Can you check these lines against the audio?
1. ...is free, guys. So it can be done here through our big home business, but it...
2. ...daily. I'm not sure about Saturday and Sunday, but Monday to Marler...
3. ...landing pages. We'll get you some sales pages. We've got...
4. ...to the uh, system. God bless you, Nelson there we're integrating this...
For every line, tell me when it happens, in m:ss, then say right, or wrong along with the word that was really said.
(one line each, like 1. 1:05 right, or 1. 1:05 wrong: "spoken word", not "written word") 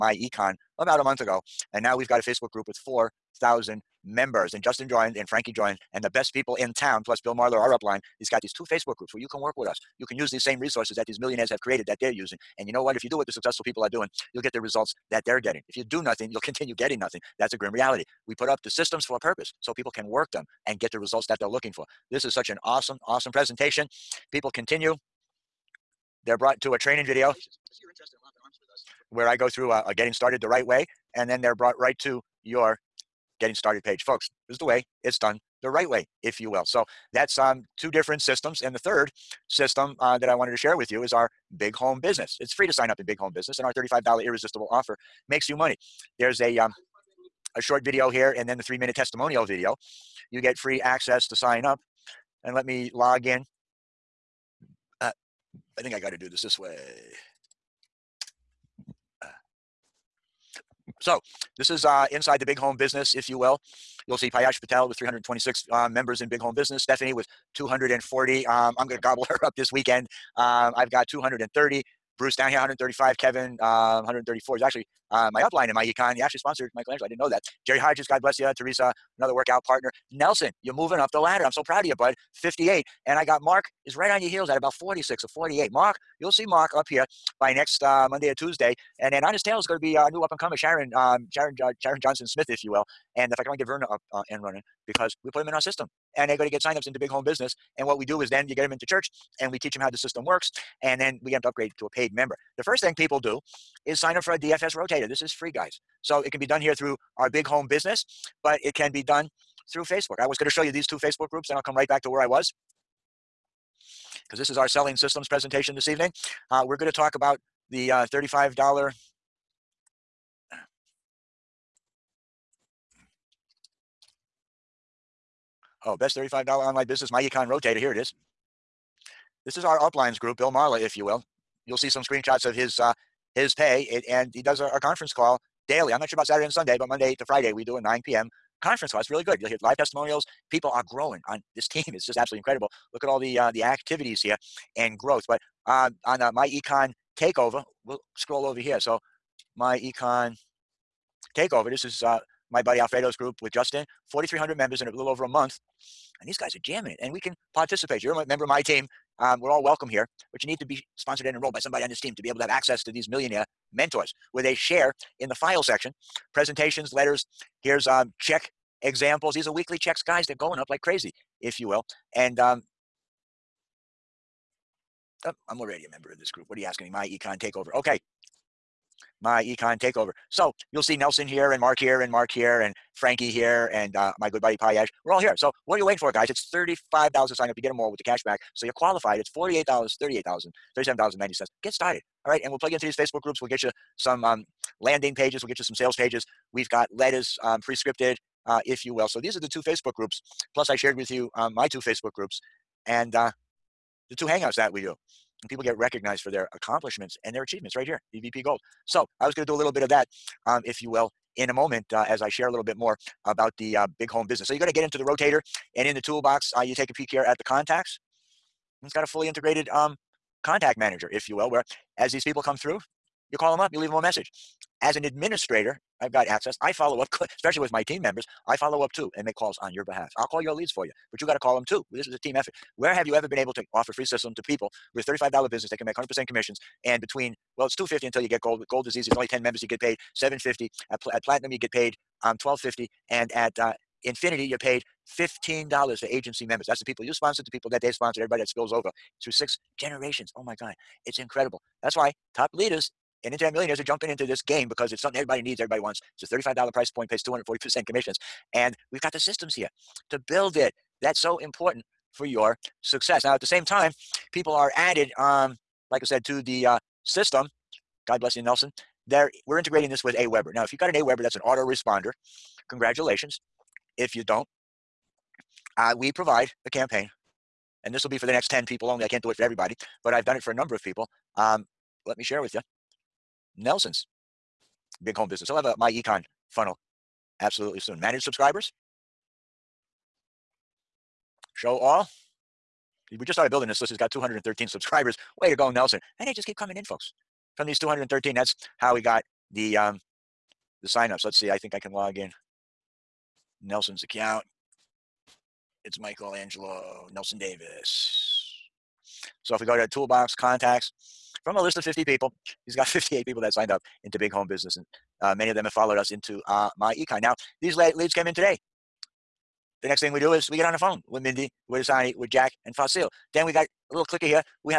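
1. 1:45 right
2. 2:15 wrong: "Friday", not "Marler"
3. 3:14 right
4. 4:26 right.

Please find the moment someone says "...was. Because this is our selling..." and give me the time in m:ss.
1:52.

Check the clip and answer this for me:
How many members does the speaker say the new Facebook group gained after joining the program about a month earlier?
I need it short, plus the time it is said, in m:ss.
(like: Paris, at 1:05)
4,000, at 0:02.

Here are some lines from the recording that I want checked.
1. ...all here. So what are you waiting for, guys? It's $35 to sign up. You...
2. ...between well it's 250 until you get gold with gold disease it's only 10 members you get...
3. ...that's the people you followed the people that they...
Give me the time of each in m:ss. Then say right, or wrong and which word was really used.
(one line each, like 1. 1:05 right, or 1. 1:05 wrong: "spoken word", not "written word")
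1. 3:05 right
2. 3:57 right
3. 4:06 wrong: "sponsored", not "followed".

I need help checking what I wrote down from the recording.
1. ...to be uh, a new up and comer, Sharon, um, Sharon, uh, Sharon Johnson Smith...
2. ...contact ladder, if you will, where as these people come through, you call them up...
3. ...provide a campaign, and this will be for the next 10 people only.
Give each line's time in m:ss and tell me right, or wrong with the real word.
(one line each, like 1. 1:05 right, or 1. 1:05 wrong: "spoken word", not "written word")
1. 1:29 right
2. 3:40 wrong: "manager", not "ladder"
3. 4:36 right.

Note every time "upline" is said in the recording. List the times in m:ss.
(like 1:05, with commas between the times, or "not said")
0:07, 1:15, 2:09.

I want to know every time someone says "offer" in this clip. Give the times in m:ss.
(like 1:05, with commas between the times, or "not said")
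0:44, 3:53.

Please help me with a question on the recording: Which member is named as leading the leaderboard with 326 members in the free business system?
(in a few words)
Piyush Patel.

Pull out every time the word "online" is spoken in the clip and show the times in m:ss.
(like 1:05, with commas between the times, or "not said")
2:06.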